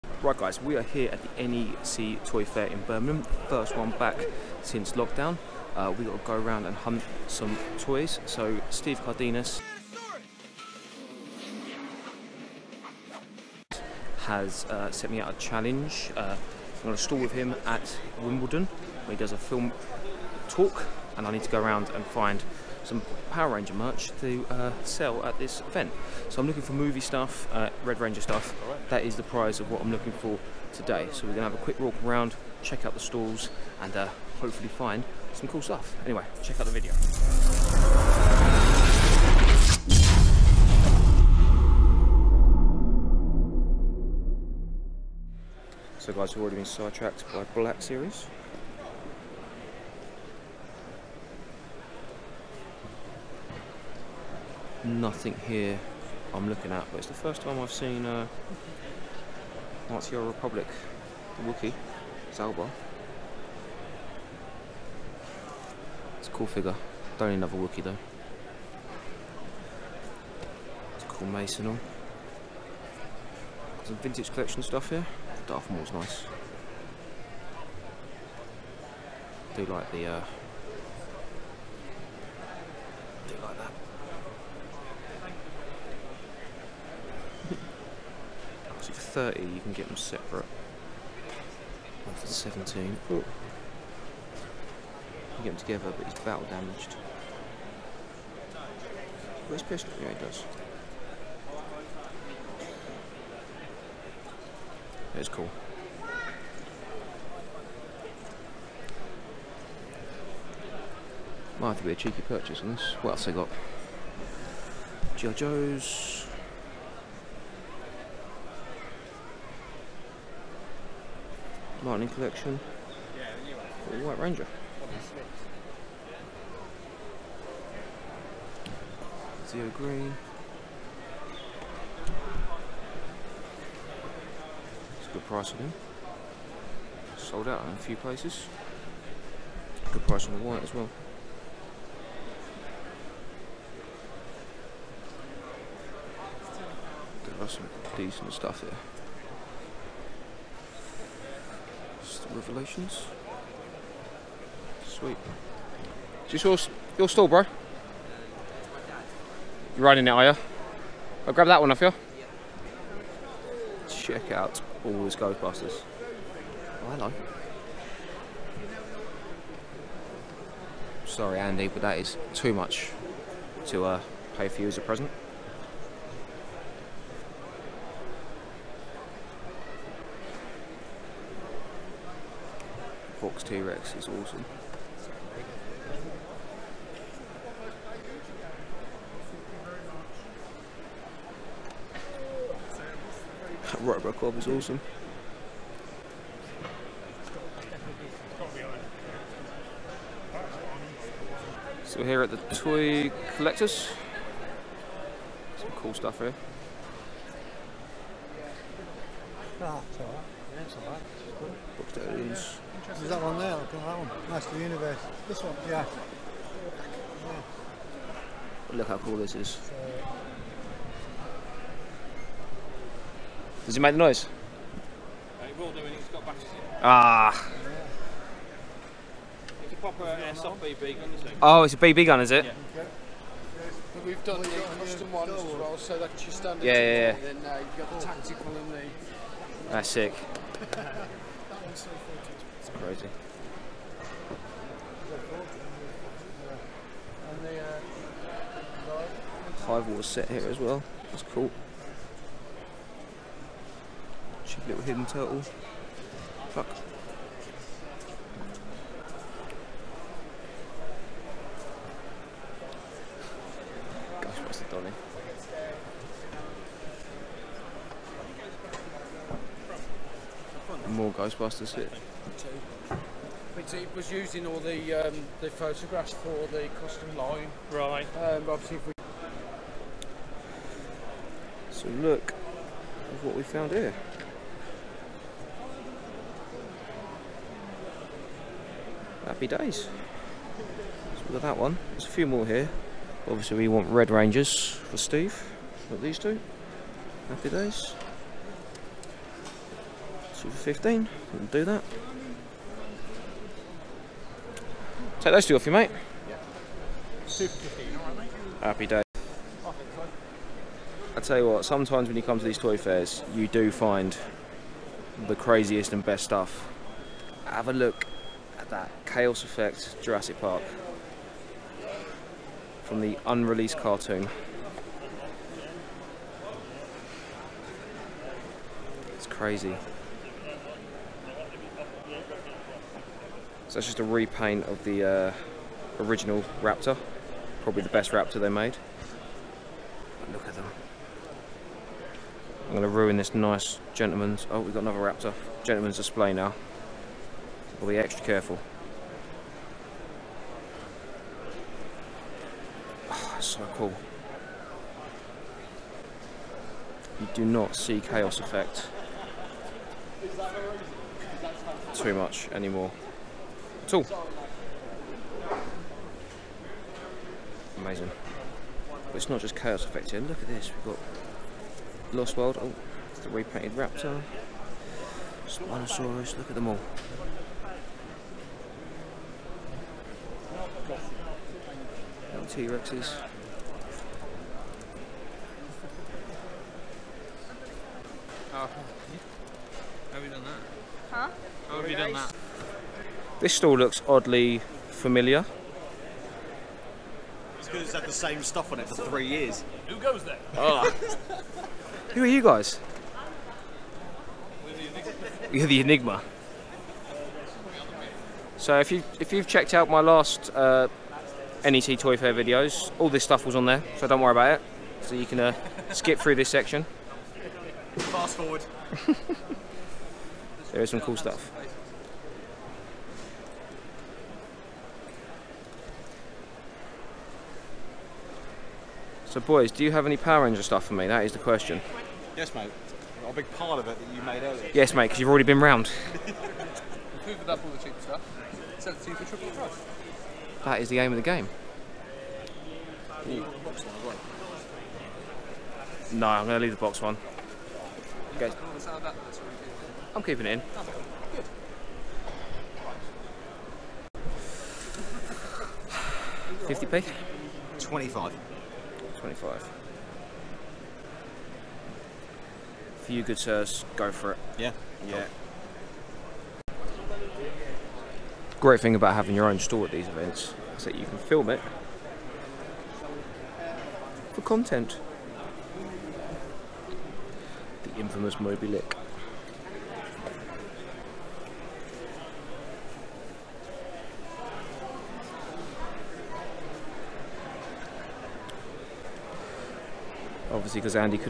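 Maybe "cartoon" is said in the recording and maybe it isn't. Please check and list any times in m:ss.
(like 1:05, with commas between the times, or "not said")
5:23.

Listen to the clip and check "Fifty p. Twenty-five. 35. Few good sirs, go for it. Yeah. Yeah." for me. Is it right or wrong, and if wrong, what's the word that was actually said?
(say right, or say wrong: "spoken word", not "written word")
wrong: "25", not "35".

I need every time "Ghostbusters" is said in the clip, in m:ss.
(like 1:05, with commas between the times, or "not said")
2:45, 4:31.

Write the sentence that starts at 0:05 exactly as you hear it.
Uh, we got to go around and hunt some toys.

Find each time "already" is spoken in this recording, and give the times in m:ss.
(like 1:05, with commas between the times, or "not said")
0:46, 7:15.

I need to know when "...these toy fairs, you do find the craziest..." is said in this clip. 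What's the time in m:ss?
5:12.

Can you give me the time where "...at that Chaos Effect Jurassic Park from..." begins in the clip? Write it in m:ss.
5:18.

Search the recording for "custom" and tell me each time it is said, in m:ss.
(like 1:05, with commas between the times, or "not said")
3:54, 4:36.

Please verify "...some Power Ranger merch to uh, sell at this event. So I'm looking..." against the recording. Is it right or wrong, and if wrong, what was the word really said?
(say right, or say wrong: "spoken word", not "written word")
right.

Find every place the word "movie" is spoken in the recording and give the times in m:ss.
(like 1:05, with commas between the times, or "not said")
0:26.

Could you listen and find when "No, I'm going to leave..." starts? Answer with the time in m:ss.
7:26.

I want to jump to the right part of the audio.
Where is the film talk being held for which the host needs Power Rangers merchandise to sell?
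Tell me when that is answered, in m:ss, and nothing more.
0:18.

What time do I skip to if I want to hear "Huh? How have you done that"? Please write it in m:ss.
6:31.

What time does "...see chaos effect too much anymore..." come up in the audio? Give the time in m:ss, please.
5:57.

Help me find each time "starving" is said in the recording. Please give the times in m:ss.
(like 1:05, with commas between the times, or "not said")
not said.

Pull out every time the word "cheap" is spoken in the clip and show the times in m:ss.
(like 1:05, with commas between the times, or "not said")
4:14, 7:17.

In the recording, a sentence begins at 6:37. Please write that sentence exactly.
It's had the same stuff on it for three years.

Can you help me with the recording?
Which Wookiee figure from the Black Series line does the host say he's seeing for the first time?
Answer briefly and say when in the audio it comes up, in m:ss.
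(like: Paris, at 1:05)
Zaalbar, at 1:02.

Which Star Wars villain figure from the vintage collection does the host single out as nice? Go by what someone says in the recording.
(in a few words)
Darth Maul.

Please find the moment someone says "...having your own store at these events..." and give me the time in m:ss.
7:49.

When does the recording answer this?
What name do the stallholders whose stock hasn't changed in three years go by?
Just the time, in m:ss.
6:45.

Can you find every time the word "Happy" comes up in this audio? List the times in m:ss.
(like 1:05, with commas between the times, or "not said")
4:49, 4:57, 5:08.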